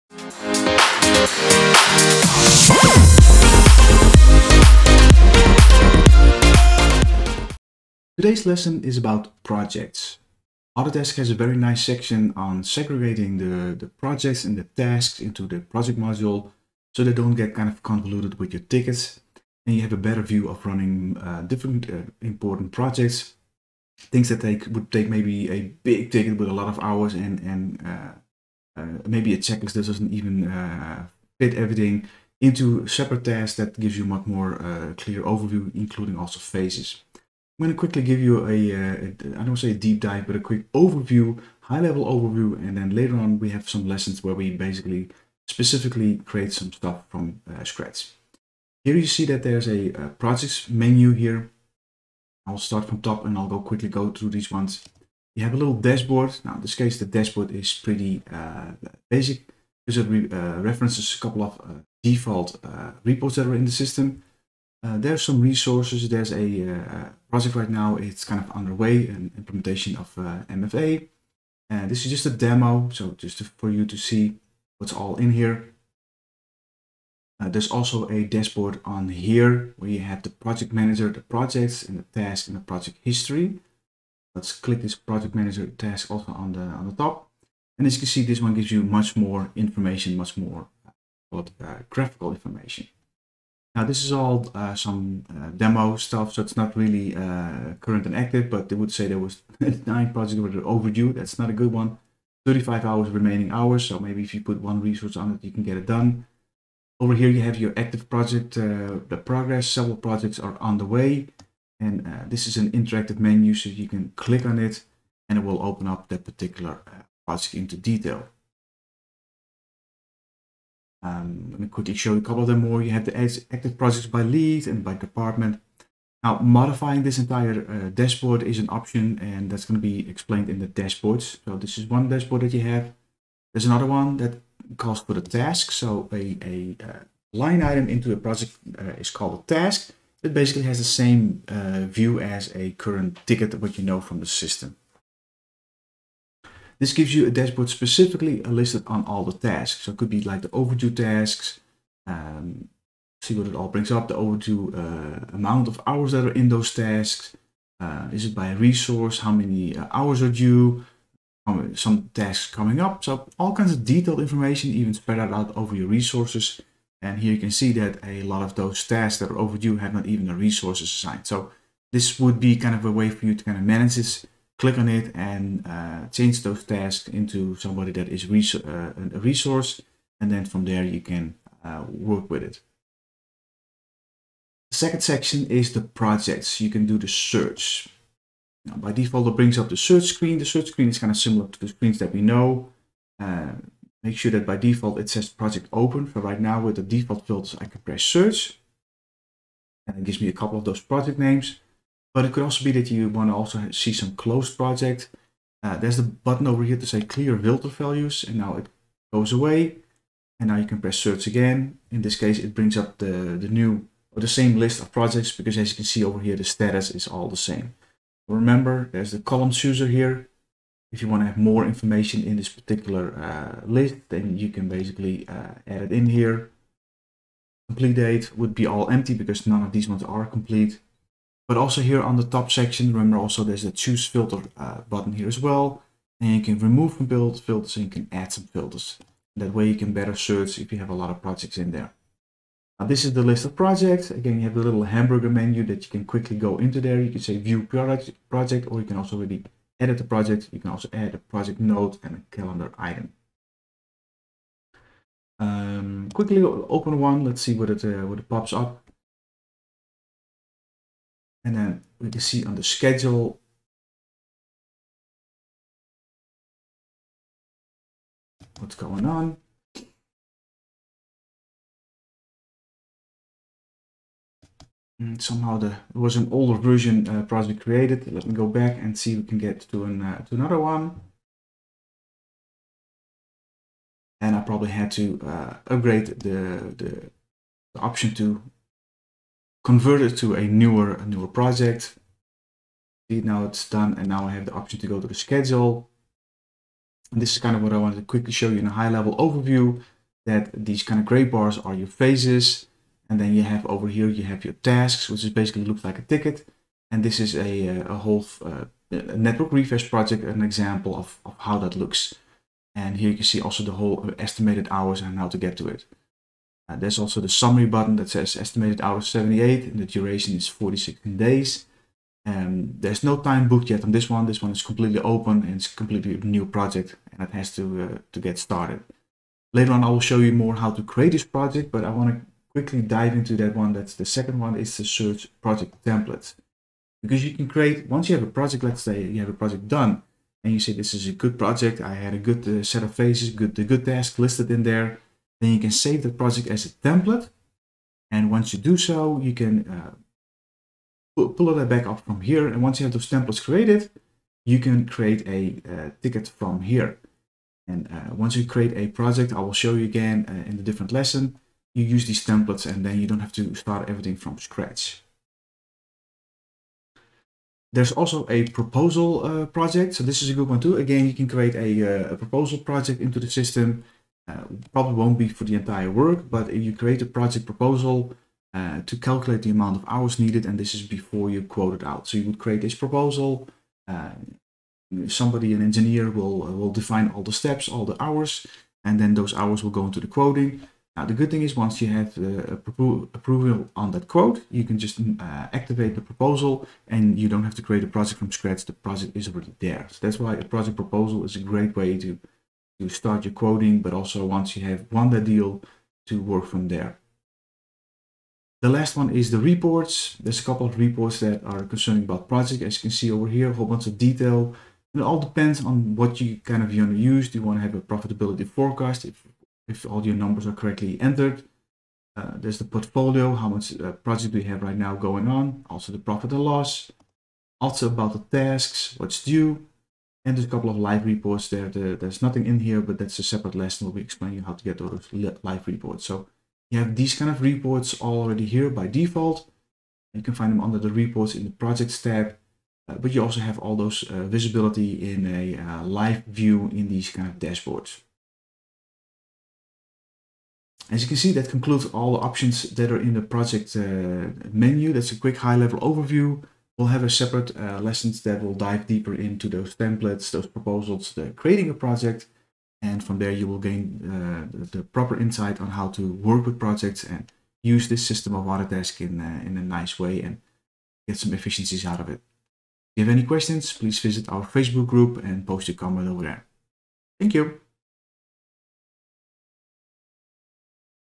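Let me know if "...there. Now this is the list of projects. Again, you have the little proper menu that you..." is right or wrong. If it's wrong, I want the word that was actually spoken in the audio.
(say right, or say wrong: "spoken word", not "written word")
wrong: "hamburger", not "proper".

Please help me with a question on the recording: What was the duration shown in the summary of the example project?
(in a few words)
46 days.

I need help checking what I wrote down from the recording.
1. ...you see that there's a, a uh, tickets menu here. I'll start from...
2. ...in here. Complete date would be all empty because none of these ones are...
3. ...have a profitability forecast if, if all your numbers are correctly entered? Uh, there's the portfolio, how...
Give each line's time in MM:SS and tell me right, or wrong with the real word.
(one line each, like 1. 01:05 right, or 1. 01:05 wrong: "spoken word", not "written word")
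1. 00:48 wrong: "projects", not "tickets"
2. 03:45 right
3. 06:57 right.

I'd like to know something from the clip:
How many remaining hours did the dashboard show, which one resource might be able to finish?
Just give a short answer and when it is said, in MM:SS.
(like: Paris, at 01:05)
35, at 01:42.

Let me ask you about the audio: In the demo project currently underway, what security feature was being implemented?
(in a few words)
MFA.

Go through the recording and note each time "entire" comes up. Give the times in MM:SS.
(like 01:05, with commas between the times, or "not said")
02:07, 06:15.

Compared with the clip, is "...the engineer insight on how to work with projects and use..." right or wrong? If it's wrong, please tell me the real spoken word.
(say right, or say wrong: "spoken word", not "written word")
wrong: "proper", not "engineer".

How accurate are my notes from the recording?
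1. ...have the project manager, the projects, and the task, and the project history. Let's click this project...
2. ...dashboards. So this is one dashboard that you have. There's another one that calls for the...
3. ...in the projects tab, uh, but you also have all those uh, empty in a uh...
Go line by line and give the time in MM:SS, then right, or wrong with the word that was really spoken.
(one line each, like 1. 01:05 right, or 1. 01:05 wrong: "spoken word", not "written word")
1. 01:19 right
2. 02:10 right
3. 07:21 wrong: "visibility", not "empty".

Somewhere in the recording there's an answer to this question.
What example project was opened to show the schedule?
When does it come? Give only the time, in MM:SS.
05:09.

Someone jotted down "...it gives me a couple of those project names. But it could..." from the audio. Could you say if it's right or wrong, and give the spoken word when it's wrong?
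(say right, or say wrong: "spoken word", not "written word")
right.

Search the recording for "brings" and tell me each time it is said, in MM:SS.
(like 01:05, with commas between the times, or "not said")
02:33, 03:09, 03:32.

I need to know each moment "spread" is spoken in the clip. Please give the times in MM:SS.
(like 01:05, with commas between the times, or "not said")
02:44.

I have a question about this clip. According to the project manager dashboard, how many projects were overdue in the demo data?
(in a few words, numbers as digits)
9.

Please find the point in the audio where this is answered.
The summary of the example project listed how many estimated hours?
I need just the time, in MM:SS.
05:19.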